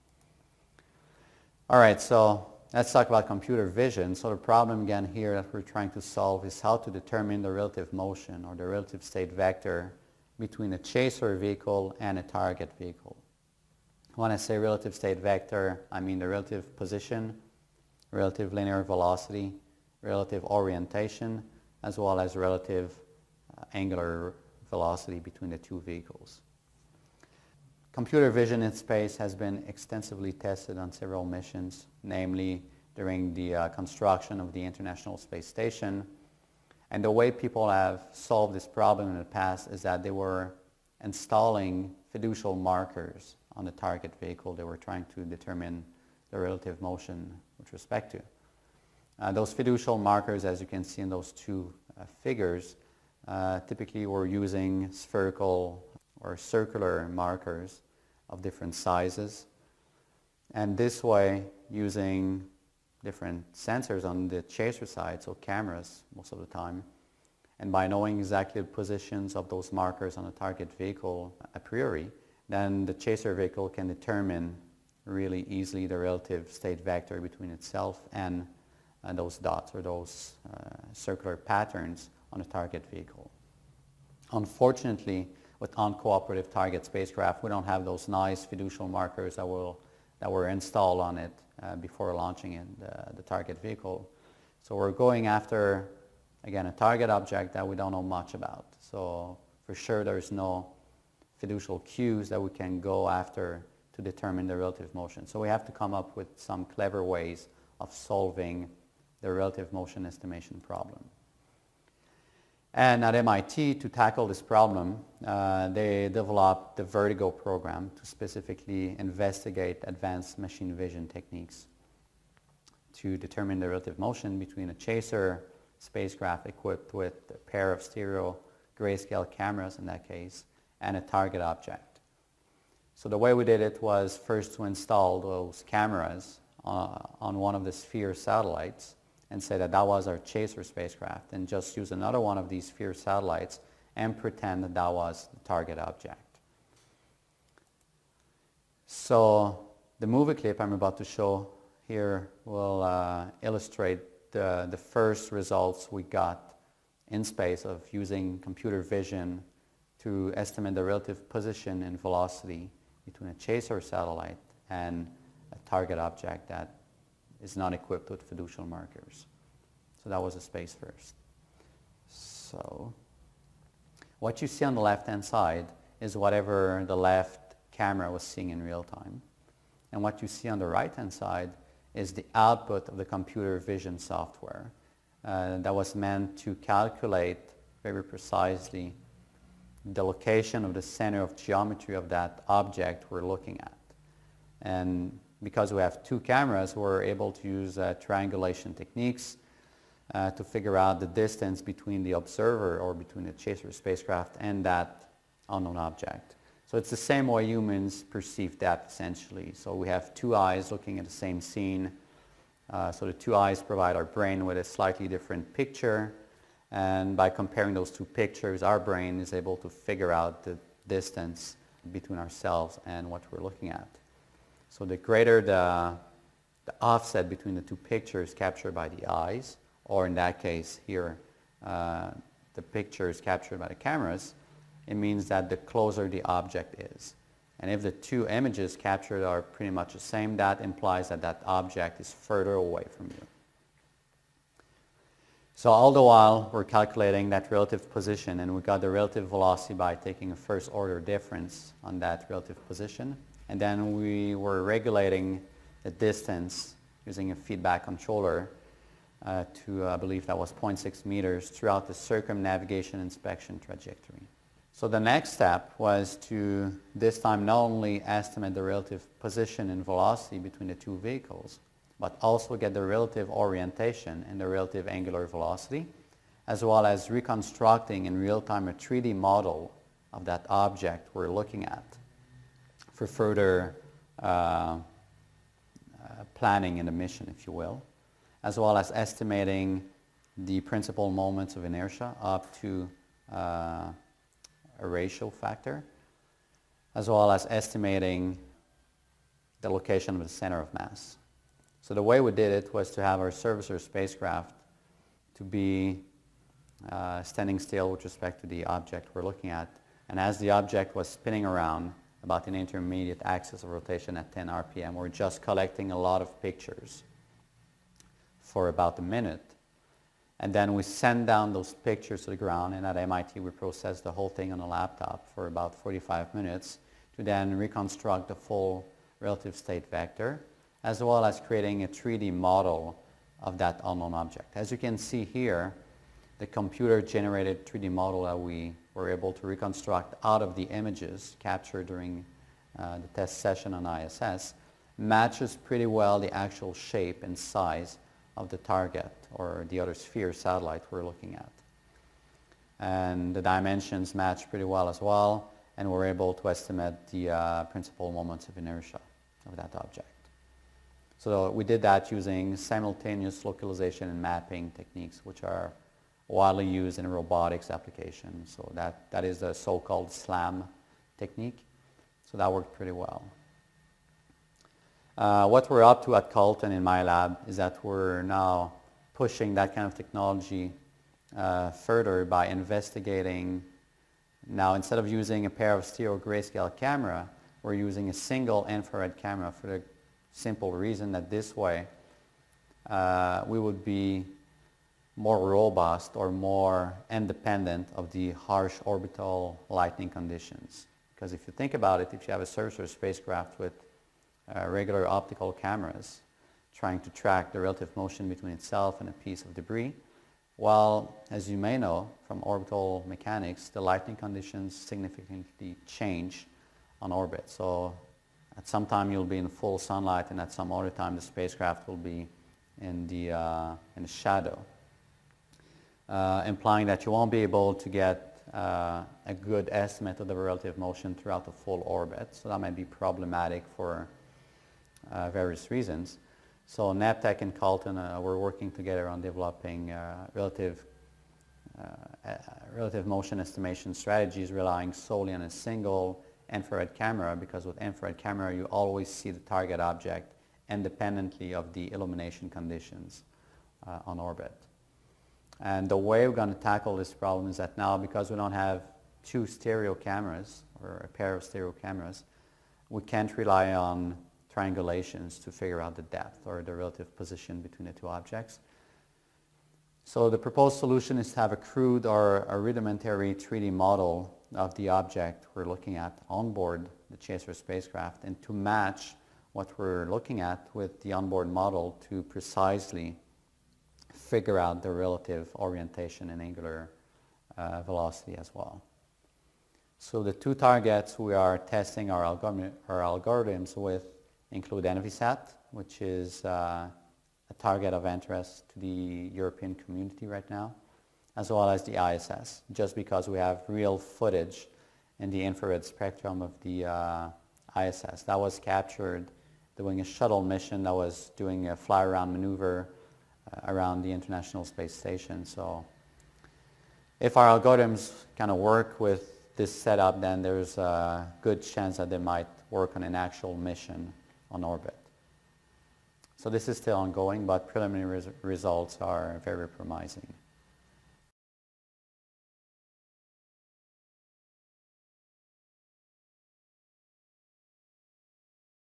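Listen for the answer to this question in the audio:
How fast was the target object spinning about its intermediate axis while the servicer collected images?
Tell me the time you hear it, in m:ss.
5:14.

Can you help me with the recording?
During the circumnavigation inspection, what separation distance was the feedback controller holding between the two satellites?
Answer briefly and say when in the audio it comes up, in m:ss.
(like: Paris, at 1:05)
0.6 meters, at 4:20.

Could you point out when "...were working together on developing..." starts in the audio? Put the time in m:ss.
7:18.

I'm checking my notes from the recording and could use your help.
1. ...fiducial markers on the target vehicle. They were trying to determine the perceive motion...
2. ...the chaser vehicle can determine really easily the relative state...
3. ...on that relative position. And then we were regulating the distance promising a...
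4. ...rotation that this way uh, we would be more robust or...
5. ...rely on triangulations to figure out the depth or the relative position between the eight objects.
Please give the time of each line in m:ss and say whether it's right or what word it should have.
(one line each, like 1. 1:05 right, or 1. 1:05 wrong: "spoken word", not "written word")
1. 0:42 wrong: "relative", not "perceive"
2. 1:12 right
3. 4:11 wrong: "using", not "promising"
4. 6:30 wrong: "reason", not "rotation"
5. 7:43 wrong: "two", not "eight".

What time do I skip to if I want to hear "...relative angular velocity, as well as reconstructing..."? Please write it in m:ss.
4:34.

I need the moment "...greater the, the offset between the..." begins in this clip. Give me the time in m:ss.
3:44.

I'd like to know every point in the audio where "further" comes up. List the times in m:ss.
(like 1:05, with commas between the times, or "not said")
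4:02, 4:43, 6:21.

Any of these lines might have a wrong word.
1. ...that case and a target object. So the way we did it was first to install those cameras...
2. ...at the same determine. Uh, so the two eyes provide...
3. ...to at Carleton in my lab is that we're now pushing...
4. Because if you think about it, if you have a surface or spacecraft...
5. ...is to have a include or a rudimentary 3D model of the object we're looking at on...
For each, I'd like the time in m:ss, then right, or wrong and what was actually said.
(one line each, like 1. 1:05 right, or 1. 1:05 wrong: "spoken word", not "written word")
1. 2:09 right
2. 3:30 wrong: "scene", not "determine"
3. 6:16 right
4. 6:41 right
5. 7:51 wrong: "crude", not "include".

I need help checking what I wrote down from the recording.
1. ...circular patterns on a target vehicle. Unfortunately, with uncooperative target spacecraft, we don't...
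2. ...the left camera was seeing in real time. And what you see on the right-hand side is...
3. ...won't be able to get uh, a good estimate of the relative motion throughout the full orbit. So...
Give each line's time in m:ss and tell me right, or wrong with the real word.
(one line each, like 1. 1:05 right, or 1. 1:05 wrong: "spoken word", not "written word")
1. 1:20 right
2. 2:56 right
3. 7:07 right.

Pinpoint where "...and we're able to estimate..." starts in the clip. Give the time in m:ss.
5:55.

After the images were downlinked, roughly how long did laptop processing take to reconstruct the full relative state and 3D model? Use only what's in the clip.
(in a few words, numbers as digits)
45 minutes.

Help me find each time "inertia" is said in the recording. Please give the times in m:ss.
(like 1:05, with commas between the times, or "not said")
4:51, 5:58.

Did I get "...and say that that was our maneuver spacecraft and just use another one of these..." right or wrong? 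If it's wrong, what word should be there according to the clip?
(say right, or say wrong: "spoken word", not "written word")
wrong: "chaser", not "maneuver".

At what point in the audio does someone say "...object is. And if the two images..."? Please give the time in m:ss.
3:56.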